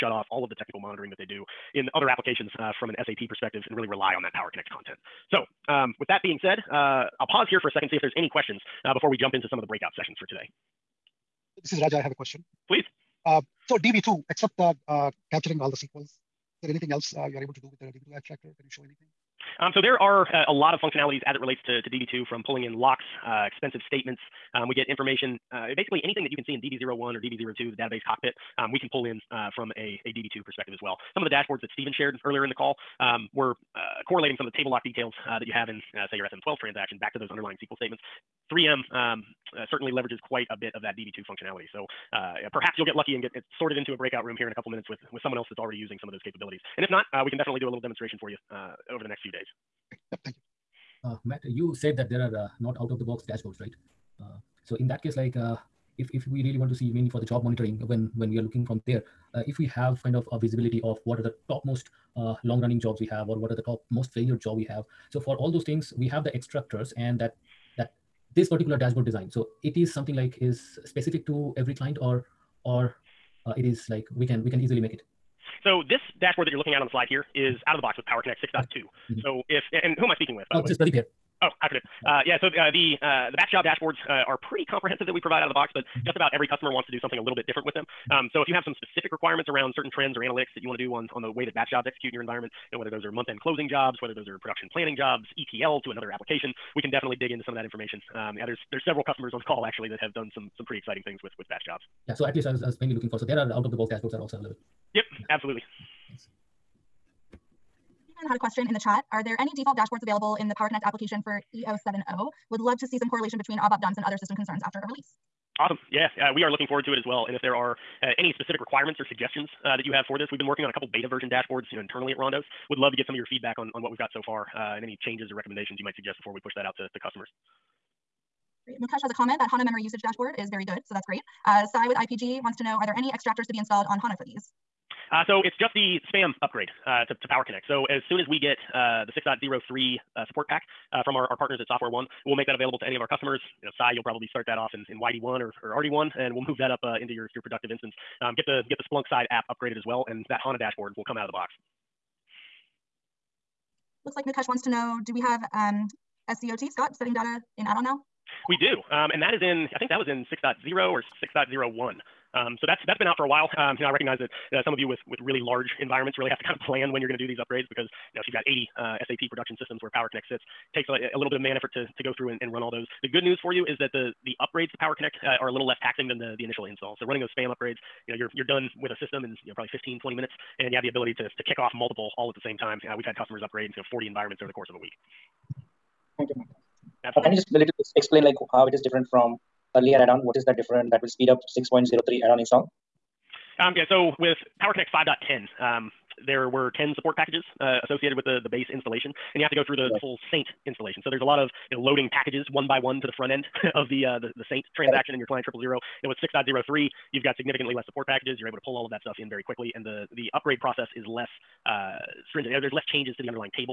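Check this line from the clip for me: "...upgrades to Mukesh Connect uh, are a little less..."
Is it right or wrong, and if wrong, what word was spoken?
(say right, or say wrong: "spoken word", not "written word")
wrong: "Power", not "Mukesh".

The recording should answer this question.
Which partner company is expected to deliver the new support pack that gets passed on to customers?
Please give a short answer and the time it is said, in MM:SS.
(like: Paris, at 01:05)
Software One, at 02:21.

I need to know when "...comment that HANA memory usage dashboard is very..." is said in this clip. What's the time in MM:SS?
02:09.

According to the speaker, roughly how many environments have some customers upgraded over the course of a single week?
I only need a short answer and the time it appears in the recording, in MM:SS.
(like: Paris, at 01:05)
40, at 03:03.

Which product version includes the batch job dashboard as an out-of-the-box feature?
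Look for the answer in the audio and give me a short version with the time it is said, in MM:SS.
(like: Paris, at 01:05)
Power Connect 6.2, at 01:18.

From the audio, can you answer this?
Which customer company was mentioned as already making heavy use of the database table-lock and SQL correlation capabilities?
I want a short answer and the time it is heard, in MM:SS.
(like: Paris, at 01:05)
3M, at 00:38.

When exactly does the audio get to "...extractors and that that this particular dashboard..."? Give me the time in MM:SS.
01:06.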